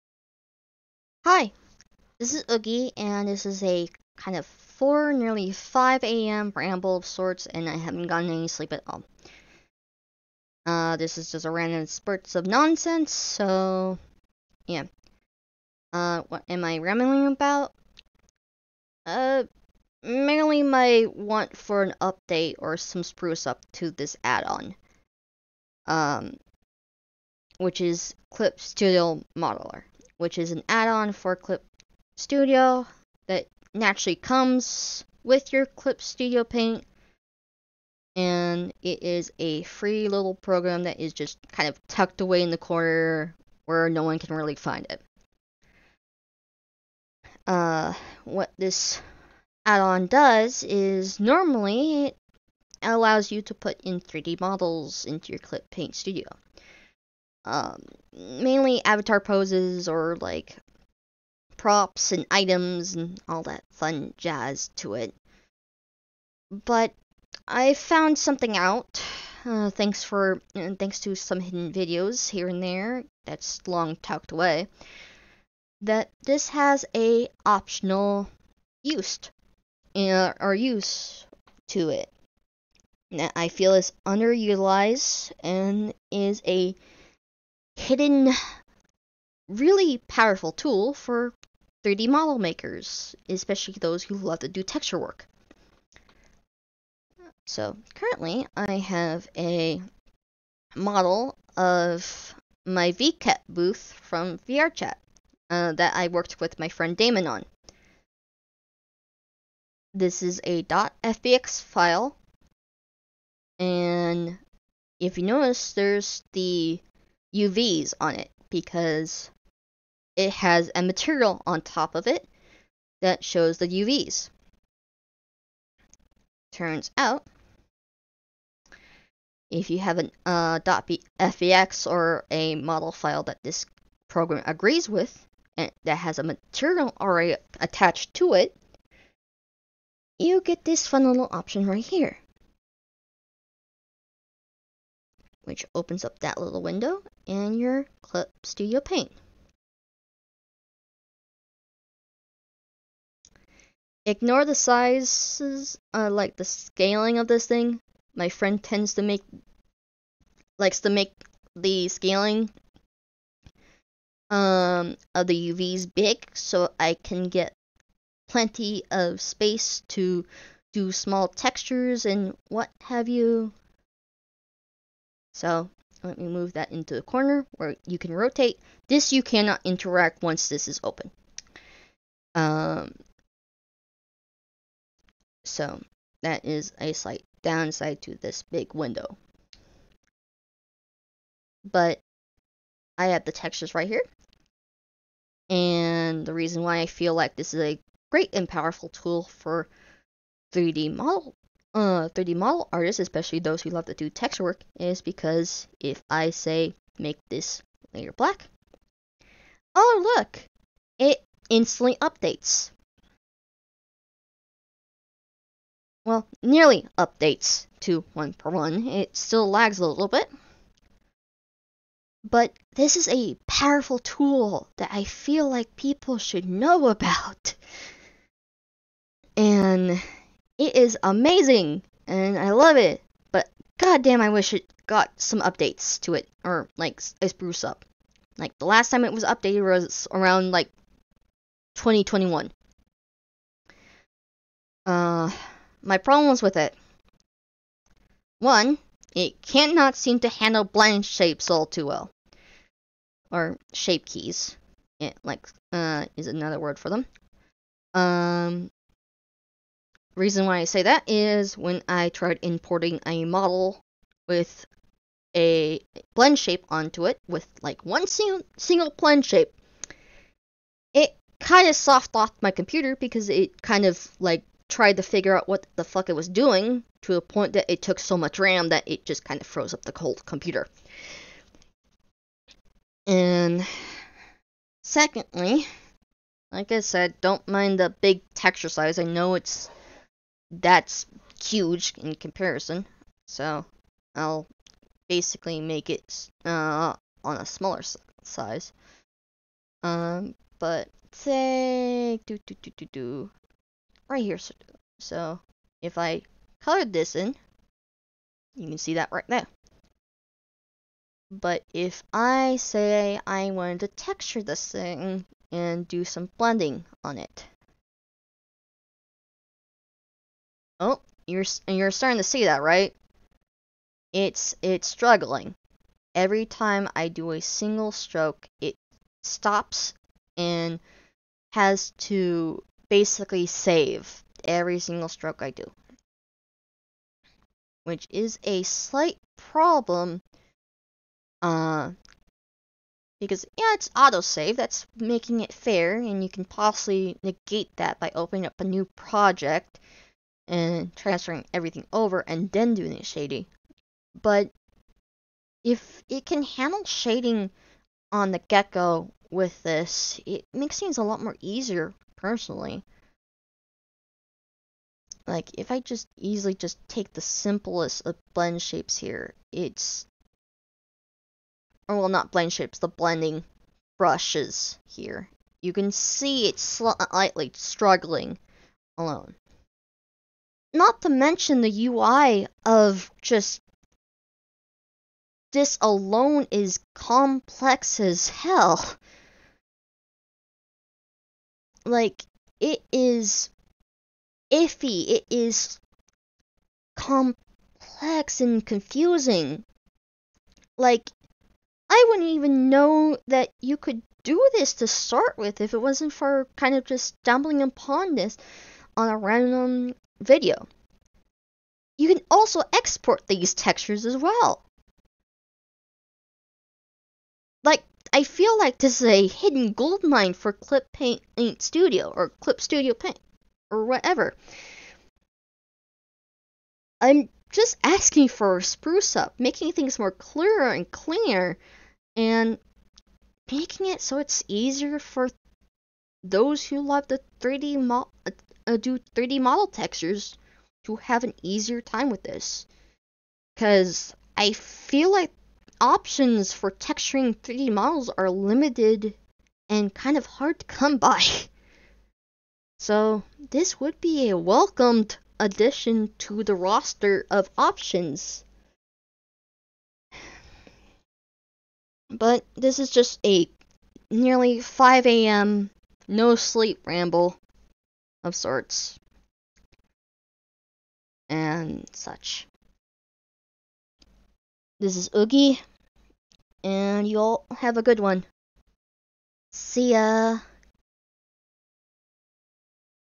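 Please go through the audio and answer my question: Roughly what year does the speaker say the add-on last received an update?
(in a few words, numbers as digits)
2021.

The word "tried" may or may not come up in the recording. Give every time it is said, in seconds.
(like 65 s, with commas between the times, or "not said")
262 s, 274 s.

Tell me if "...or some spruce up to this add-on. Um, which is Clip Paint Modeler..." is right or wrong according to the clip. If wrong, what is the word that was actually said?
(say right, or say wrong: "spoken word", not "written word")
wrong: "Studio", not "Paint".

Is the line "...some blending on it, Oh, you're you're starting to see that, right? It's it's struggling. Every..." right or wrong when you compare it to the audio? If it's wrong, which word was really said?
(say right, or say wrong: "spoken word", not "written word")
right.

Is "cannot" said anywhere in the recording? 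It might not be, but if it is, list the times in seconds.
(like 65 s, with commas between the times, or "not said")
179 s, 249 s.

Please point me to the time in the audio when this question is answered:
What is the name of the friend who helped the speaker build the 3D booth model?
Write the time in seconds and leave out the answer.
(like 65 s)
106 s.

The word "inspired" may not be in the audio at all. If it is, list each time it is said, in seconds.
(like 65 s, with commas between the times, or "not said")
not said.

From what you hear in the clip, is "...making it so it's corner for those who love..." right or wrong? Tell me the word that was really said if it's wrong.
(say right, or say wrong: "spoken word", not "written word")
wrong: "easier", not "corner".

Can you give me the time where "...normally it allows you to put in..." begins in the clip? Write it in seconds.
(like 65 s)
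51 s.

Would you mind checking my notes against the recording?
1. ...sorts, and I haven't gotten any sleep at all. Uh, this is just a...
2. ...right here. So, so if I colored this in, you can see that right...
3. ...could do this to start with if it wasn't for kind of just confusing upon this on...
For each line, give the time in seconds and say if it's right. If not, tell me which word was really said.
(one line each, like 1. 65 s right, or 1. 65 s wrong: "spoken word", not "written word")
1. 7 s right
2. 304 s right
3. 403 s wrong: "stumbling", not "confusing".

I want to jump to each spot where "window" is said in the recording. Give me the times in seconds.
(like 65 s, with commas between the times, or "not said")
146 s, 188 s.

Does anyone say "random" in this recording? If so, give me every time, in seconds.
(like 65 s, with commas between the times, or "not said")
11 s, 409 s.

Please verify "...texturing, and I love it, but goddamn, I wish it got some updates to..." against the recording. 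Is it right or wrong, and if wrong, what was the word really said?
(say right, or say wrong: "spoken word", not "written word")
wrong: "amazing", not "texturing".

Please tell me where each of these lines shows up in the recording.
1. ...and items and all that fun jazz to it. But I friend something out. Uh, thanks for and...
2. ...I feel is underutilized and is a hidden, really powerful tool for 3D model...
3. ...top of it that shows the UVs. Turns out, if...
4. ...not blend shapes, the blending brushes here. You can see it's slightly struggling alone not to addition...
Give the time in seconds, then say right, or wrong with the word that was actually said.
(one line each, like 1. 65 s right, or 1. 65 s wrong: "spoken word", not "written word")
1. 62 s wrong: "found", not "friend"
2. 83 s right
3. 121 s right
4. 372 s wrong: "mention", not "addition".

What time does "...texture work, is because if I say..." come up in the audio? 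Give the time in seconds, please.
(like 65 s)
204 s.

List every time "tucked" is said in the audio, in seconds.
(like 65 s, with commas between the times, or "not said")
41 s, 73 s.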